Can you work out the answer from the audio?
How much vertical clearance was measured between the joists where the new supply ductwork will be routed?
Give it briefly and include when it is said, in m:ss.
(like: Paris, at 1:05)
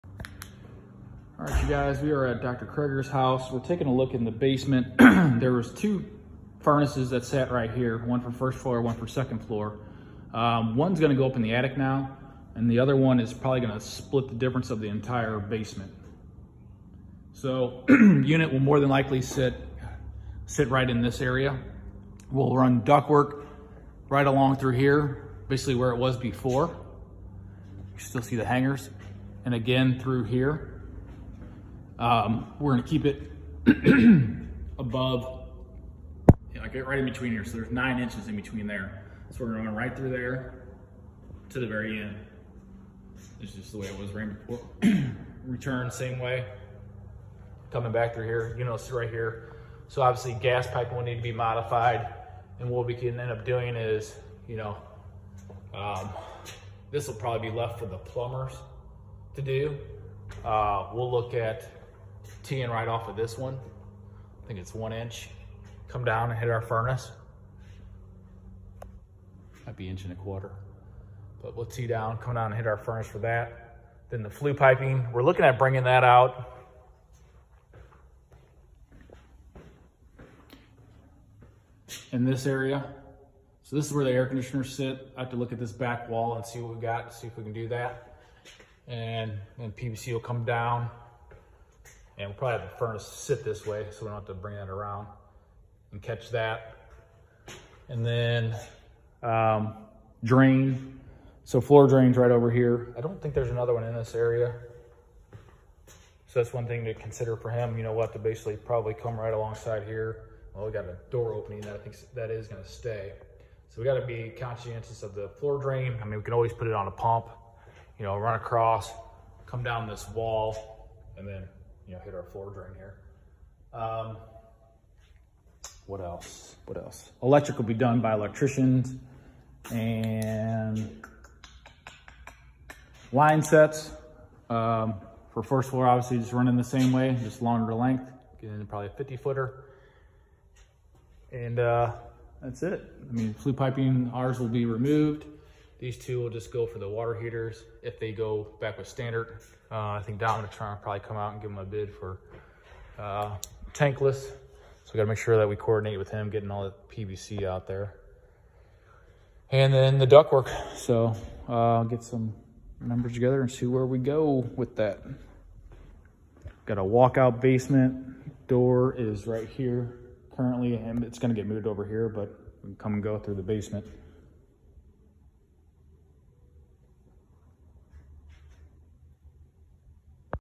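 9 inches, at 0:37.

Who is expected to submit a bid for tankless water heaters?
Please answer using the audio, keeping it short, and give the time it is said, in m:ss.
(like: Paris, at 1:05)
Dominatron, at 2:30.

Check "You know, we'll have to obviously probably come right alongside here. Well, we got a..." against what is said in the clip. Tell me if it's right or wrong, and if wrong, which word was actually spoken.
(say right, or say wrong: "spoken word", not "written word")
wrong: "basically", not "obviously".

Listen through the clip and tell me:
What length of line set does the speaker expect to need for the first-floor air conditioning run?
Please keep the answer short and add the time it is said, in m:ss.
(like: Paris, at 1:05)
50 footer, at 2:18.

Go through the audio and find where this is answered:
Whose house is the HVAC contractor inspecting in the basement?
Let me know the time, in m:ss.
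0:02.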